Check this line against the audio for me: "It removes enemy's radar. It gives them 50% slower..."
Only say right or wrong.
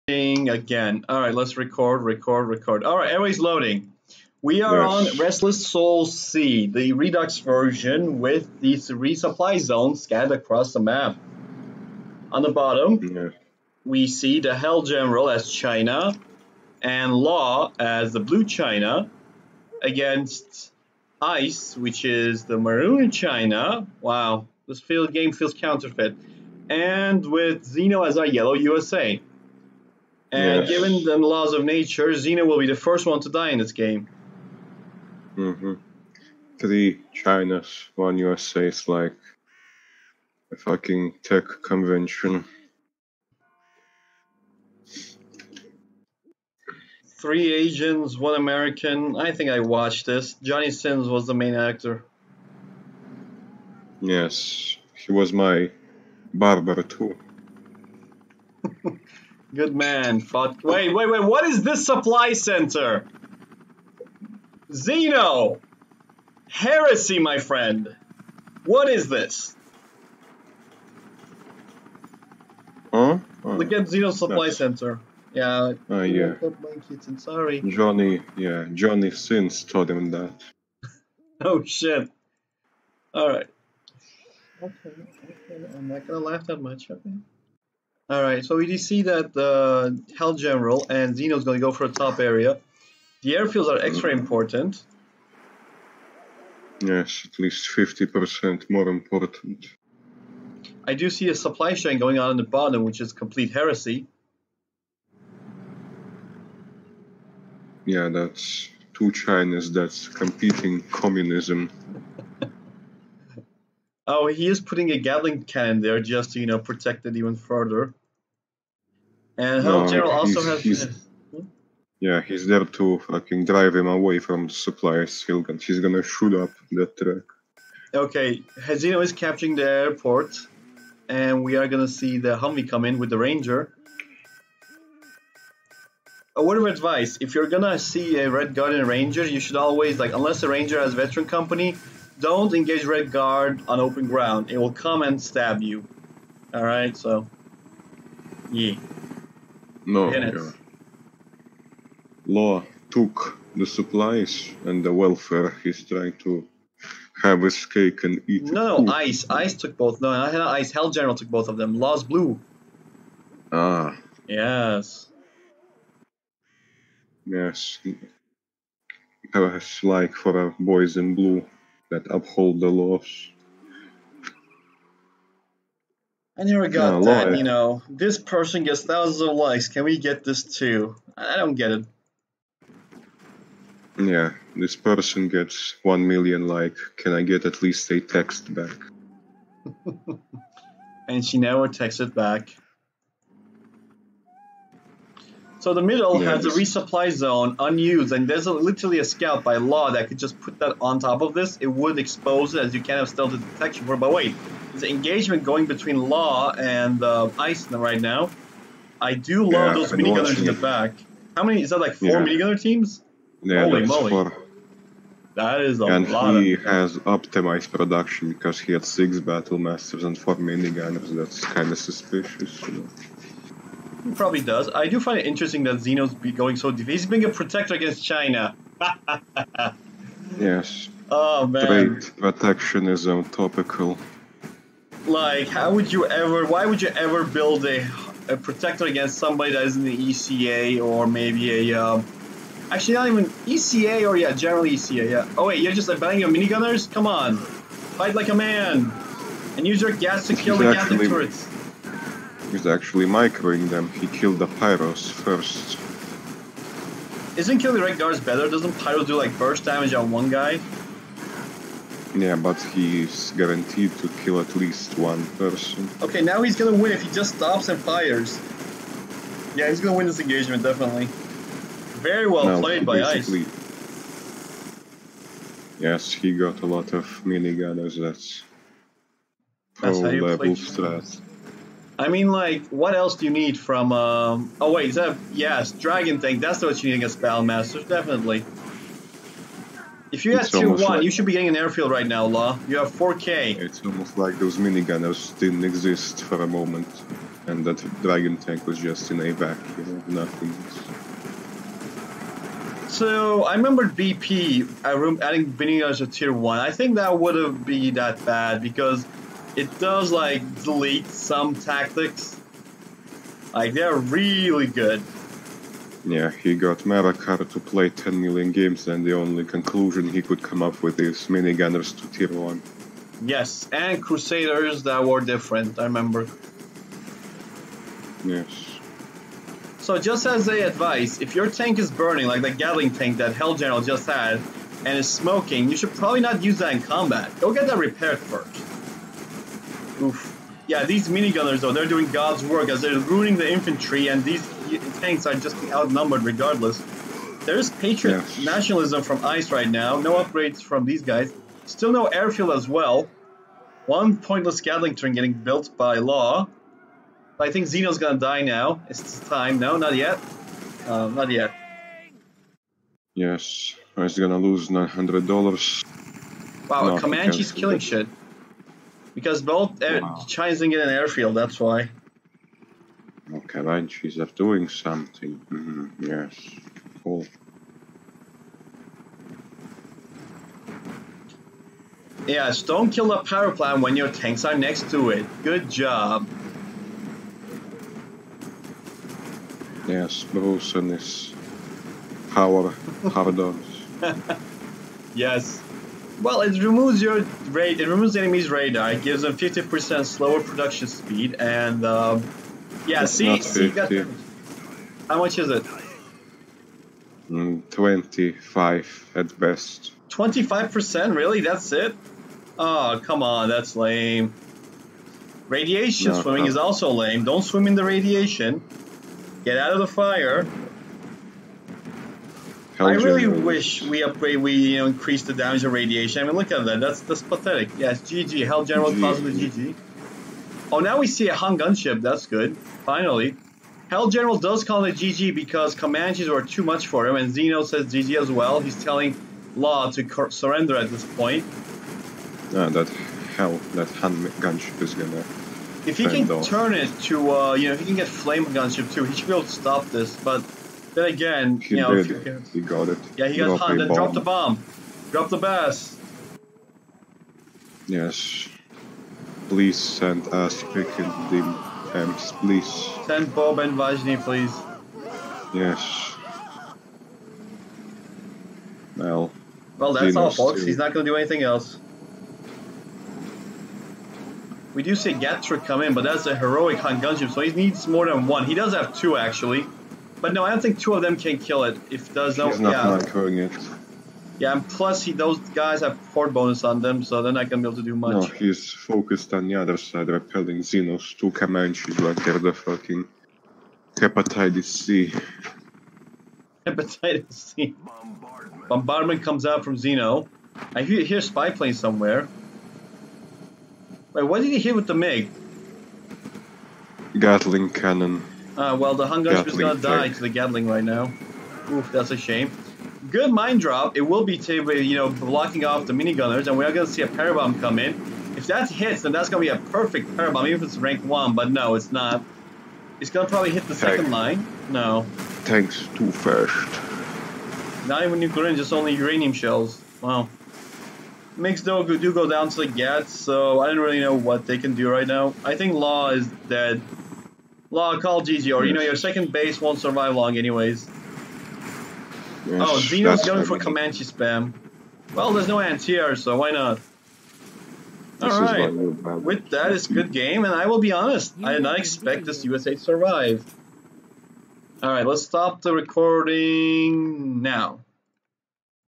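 right.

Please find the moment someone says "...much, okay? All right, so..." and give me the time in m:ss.
1:26.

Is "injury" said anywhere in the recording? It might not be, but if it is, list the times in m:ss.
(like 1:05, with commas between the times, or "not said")
not said.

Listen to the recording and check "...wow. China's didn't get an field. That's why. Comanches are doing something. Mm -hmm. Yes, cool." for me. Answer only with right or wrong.
wrong.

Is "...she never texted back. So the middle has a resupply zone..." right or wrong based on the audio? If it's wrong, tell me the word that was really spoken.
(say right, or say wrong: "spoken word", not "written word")
right.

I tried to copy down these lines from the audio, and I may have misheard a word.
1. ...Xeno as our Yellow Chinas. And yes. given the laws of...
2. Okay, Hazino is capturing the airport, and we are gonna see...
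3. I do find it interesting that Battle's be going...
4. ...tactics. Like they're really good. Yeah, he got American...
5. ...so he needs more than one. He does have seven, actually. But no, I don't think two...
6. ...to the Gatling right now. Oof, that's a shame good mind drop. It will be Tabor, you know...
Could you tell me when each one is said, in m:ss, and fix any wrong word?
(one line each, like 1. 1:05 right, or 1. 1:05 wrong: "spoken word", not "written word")
1. 0:27 wrong: "USA", not "Chinas"
2. 2:07 right
3. 3:44 wrong: "Xeno", not "Battle"
4. 5:11 wrong: "Marakar", not "American"
5. 7:57 wrong: "two", not "seven"
6. 8:30 right.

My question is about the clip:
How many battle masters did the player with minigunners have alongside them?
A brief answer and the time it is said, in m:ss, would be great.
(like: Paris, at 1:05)
Six, at 3:38.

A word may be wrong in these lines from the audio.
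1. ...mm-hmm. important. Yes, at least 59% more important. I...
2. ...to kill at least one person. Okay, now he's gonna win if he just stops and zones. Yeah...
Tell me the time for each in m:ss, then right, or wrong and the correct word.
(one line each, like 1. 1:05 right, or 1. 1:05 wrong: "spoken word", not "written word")
1. 1:34 wrong: "50", not "59"
2. 4:23 wrong: "fires", not "zones".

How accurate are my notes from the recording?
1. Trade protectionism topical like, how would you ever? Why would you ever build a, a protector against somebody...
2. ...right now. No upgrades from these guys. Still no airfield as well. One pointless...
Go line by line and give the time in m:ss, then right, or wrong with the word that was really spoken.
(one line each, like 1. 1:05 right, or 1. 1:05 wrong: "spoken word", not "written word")
1. 3:52 right
2. 5:49 right.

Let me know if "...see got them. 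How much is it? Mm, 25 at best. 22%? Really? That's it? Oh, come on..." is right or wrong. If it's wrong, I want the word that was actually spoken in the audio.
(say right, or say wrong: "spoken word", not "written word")
wrong: "25", not "22".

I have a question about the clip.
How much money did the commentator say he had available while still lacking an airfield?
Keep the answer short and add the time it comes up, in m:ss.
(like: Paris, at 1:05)
4K, at 4:52.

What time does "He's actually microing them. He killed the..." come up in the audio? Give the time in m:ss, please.
4:12.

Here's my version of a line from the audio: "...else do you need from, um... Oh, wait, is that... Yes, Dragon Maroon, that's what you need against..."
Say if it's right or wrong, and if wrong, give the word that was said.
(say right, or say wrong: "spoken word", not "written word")
wrong: "Tank", not "Maroon".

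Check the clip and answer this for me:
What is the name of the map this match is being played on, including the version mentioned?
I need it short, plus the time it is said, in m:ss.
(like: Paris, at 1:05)
Restless Soul C, at 0:05.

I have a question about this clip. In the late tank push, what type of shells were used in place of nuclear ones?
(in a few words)
Uranium shells.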